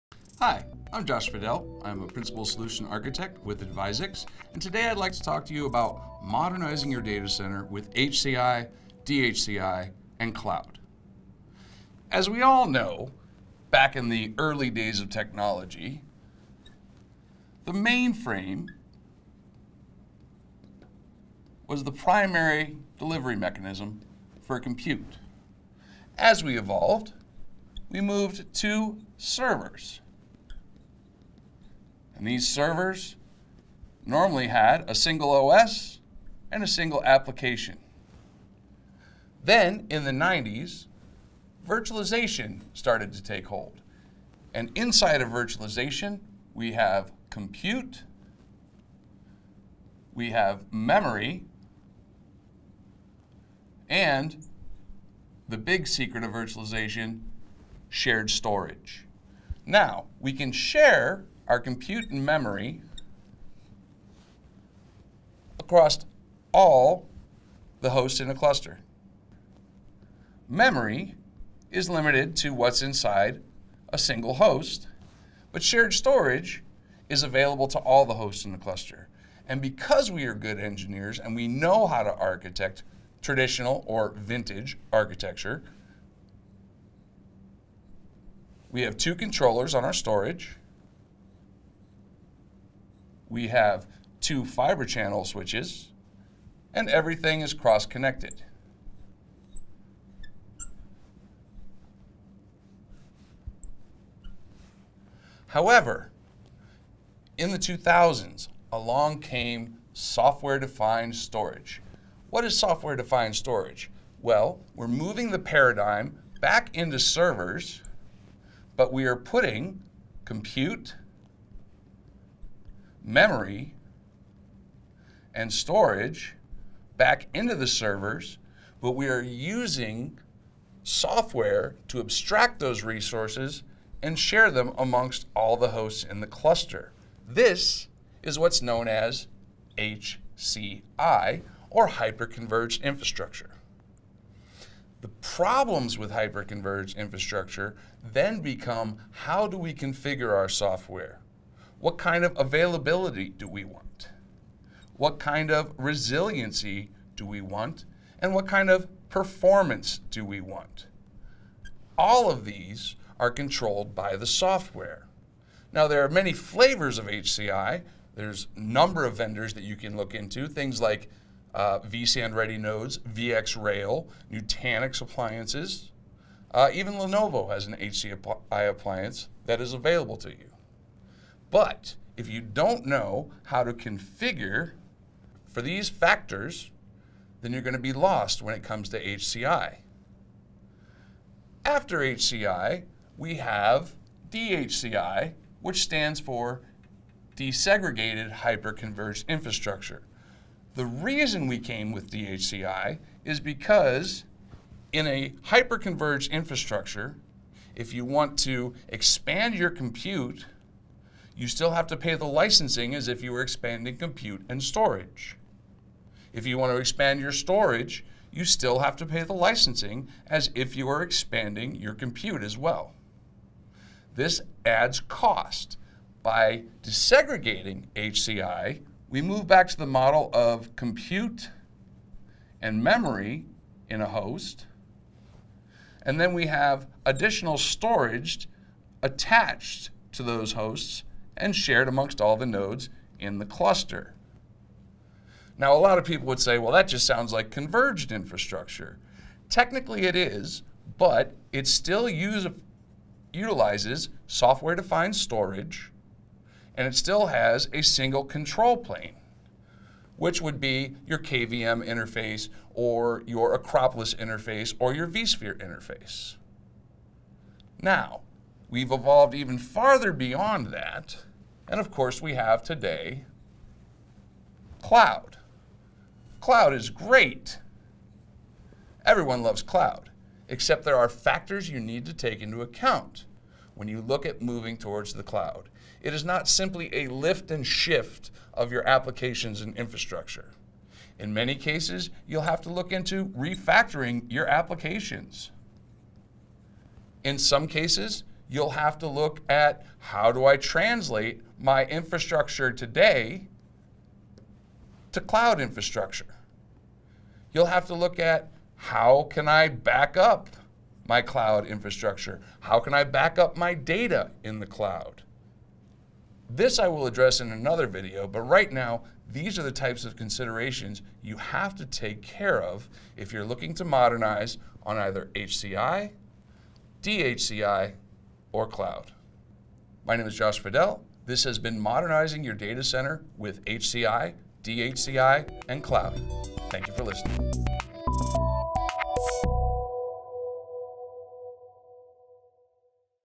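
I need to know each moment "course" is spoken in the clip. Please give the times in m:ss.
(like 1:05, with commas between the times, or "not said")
4:31.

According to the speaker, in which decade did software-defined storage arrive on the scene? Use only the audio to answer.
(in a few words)
the 2000s.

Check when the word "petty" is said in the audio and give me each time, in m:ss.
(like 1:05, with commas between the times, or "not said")
not said.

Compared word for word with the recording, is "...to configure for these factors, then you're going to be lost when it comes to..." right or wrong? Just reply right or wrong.
right.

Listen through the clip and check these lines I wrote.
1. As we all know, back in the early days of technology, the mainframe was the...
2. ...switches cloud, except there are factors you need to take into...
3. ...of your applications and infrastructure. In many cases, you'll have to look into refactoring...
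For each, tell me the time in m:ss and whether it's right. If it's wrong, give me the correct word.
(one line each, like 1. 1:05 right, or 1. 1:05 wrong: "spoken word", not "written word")
1. 0:12 right
2. 4:39 wrong: "loves", not "switches"
3. 4:48 right.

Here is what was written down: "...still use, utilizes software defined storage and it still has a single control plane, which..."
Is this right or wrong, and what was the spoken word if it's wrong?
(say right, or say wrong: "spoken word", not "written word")
right.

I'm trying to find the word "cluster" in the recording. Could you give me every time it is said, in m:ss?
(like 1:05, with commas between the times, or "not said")
1:08, 1:18, 2:16, 4:03.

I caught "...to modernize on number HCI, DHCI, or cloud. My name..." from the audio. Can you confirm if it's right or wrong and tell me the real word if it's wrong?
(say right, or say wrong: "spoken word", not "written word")
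wrong: "either", not "number".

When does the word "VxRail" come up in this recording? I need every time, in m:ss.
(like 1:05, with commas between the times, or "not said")
2:52.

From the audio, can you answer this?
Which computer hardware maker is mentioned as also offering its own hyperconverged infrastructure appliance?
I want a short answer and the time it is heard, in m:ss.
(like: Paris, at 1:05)
Lenovo, at 2:56.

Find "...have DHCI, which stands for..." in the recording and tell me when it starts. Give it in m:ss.
3:13.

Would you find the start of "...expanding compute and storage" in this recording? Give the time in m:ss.
3:33.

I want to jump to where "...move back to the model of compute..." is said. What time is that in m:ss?
3:49.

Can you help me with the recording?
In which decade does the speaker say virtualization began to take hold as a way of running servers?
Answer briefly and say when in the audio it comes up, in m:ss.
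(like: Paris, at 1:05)
the 90s, at 0:39.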